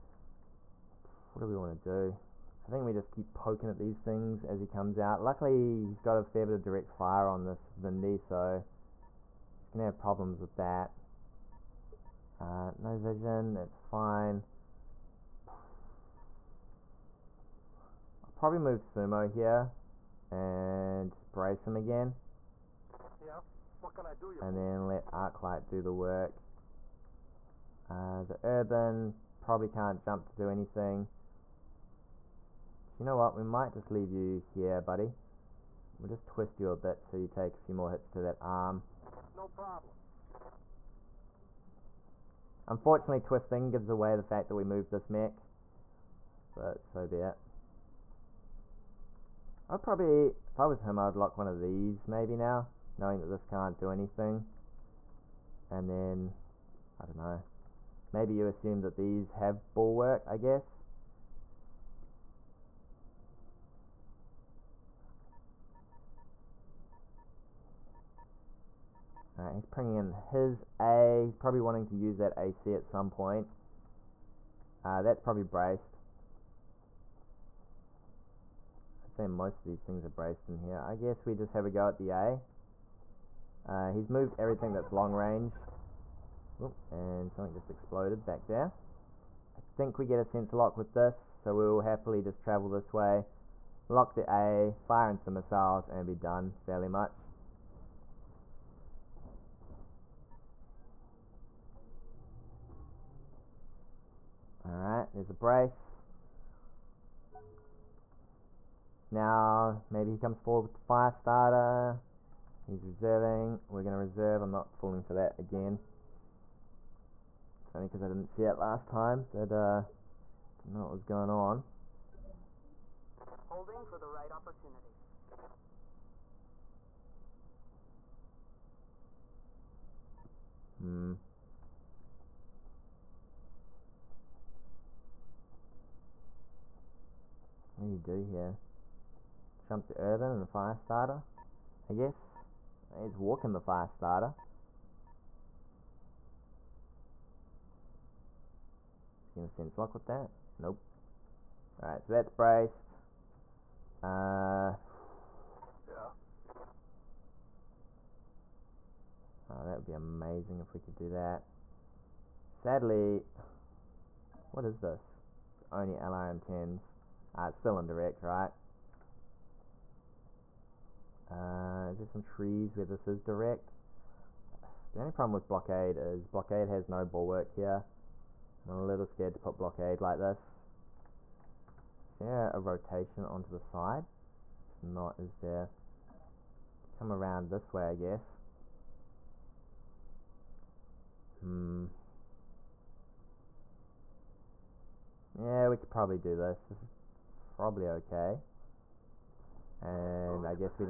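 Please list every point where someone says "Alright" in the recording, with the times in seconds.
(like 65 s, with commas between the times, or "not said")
104 s, 151 s.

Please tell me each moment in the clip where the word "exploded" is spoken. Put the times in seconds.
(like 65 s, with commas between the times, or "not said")
87 s.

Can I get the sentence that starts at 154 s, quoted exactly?
Uh Oh, that would be amazing if we could do that.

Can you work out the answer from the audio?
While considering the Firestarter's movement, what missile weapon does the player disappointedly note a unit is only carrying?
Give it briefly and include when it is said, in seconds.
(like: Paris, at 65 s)
LRM10s, at 165 s.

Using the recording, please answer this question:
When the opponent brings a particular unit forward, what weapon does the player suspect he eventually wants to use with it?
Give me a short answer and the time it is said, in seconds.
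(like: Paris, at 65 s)
AC, at 72 s.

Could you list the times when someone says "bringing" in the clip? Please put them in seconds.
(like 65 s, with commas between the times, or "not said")
69 s.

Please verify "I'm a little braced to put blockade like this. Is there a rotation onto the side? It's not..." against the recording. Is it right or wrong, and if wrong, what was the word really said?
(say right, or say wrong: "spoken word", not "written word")
wrong: "scared", not "braced".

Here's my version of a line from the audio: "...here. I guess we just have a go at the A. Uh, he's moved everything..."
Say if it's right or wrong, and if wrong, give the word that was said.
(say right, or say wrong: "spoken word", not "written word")
right.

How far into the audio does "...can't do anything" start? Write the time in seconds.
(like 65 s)
53 s.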